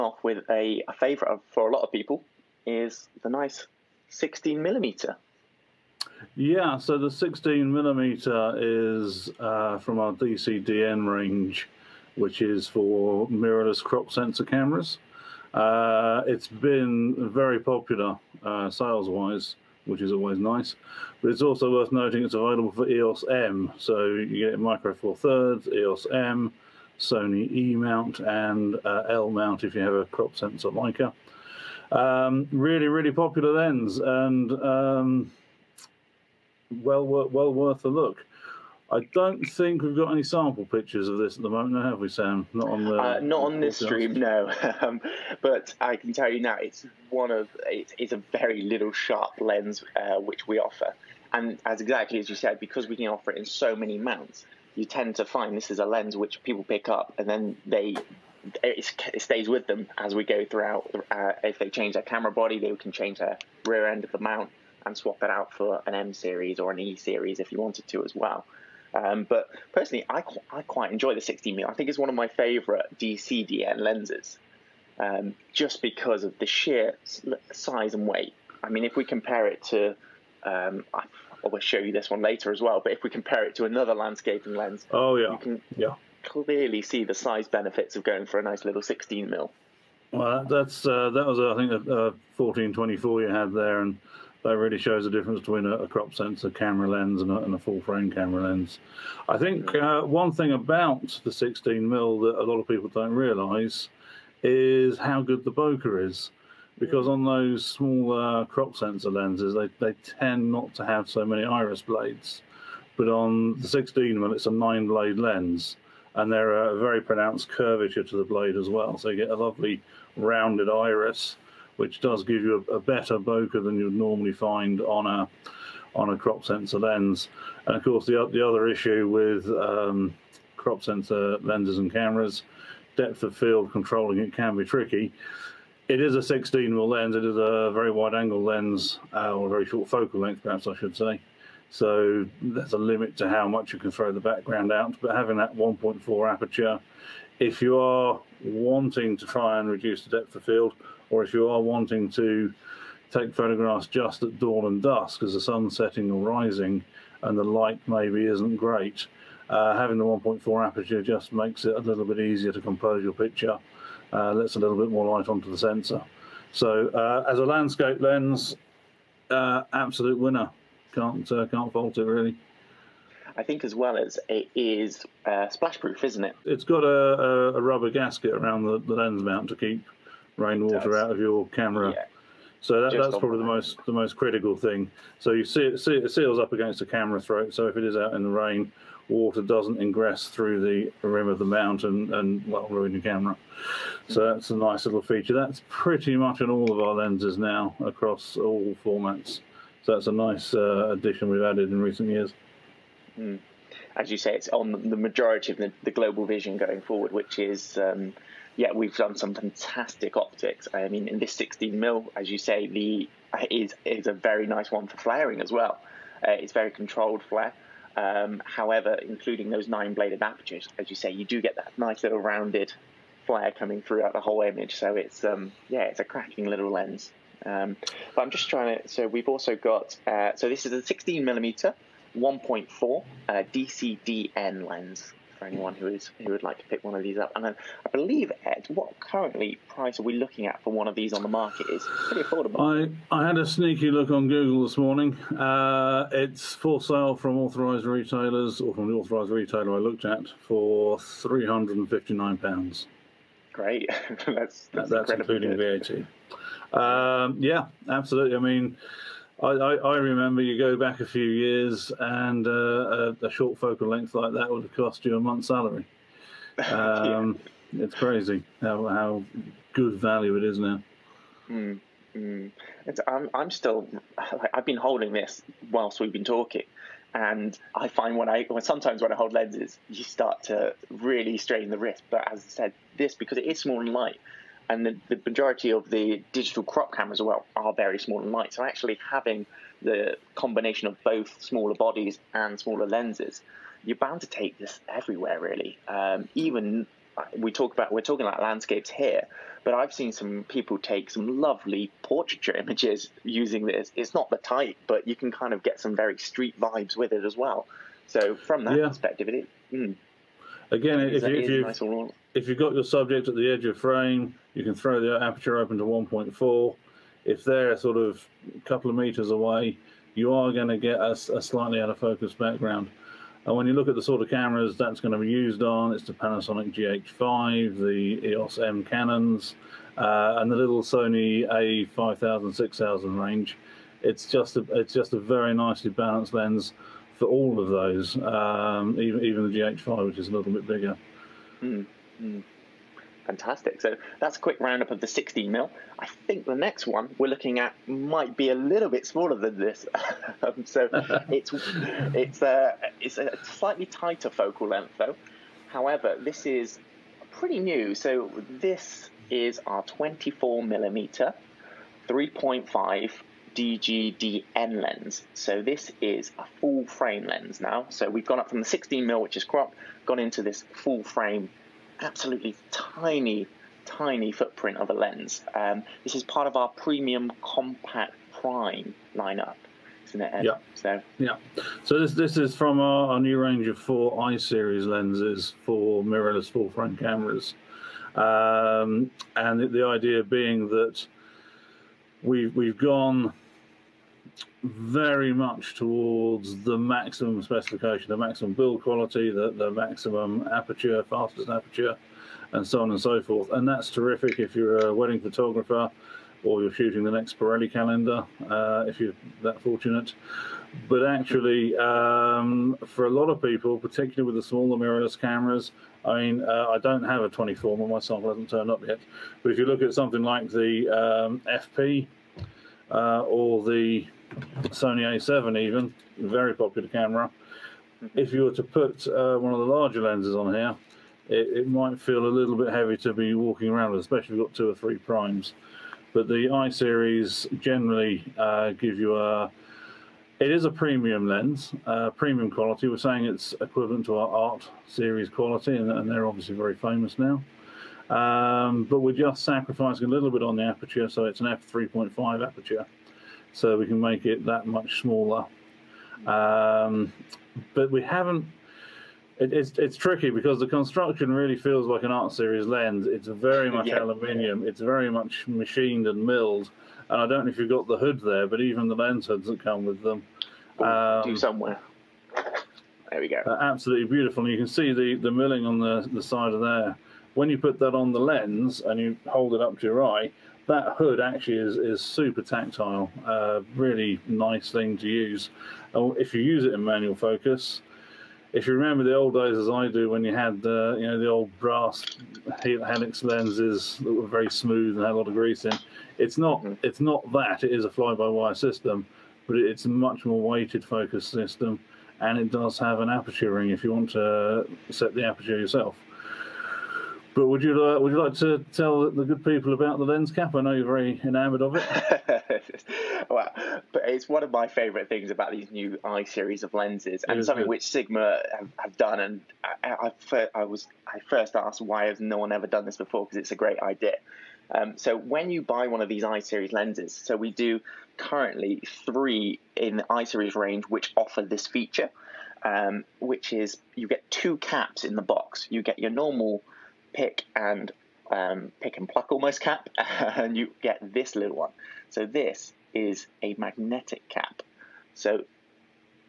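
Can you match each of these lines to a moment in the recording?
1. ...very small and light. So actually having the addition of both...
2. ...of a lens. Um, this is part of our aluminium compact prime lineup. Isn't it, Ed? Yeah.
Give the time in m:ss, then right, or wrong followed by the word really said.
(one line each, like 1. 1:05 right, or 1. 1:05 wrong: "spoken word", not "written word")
1. 4:47 wrong: "combination", not "addition"
2. 6:14 wrong: "premium", not "aluminium".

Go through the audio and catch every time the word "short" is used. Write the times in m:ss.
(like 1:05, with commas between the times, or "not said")
2:19, 4:23.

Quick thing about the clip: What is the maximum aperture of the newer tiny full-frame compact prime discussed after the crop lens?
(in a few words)
3.5.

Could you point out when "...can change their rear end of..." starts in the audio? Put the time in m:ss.
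1:02.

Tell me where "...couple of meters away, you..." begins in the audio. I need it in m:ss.
5:18.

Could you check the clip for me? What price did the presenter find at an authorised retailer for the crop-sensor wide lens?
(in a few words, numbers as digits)
£359.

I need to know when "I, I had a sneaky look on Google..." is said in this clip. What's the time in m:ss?
4:03.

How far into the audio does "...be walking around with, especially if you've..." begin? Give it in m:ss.
7:13.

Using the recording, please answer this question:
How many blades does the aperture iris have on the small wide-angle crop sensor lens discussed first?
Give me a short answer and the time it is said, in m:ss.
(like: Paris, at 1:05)
9, at 1:54.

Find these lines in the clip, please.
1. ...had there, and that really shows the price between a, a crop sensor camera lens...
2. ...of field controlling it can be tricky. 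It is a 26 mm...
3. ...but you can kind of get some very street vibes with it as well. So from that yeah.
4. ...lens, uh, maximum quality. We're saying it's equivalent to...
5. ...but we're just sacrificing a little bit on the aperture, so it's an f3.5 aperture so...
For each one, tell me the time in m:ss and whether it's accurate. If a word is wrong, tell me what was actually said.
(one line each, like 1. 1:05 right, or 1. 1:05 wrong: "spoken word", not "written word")
1. 1:33 wrong: "difference", not "price"
2. 2:13 wrong: "16", not "26"
3. 5:04 right
4. 7:21 wrong: "premium", not "maximum"
5. 7:28 right.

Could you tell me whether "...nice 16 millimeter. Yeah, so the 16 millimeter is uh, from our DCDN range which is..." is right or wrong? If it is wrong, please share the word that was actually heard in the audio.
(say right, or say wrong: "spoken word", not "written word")
right.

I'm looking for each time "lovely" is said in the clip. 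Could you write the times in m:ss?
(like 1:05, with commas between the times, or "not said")
1:59, 5:01.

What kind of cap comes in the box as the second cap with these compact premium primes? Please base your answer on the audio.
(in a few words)
magnetic cap.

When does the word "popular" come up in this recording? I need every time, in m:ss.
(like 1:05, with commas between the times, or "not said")
0:17, 0:33, 7:06.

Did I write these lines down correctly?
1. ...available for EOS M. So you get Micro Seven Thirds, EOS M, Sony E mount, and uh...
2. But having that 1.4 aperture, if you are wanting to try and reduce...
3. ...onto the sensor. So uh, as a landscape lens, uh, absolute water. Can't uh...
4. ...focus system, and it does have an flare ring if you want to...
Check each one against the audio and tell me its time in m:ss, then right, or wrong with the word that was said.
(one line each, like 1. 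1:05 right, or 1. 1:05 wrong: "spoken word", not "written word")
1. 0:22 wrong: "Four", not "Seven"
2. 2:25 right
3. 2:45 wrong: "winner", not "water"
4. 8:20 wrong: "aperture", not "flare".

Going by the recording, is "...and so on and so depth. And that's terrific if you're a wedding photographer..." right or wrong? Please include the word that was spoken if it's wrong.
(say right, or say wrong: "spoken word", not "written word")
wrong: "forth", not "depth".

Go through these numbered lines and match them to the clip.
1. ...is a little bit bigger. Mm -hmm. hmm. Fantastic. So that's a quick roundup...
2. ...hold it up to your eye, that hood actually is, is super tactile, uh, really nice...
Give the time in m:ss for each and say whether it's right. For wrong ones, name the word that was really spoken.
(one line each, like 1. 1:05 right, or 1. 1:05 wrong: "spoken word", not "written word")
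1. 5:40 right
2. 7:59 right.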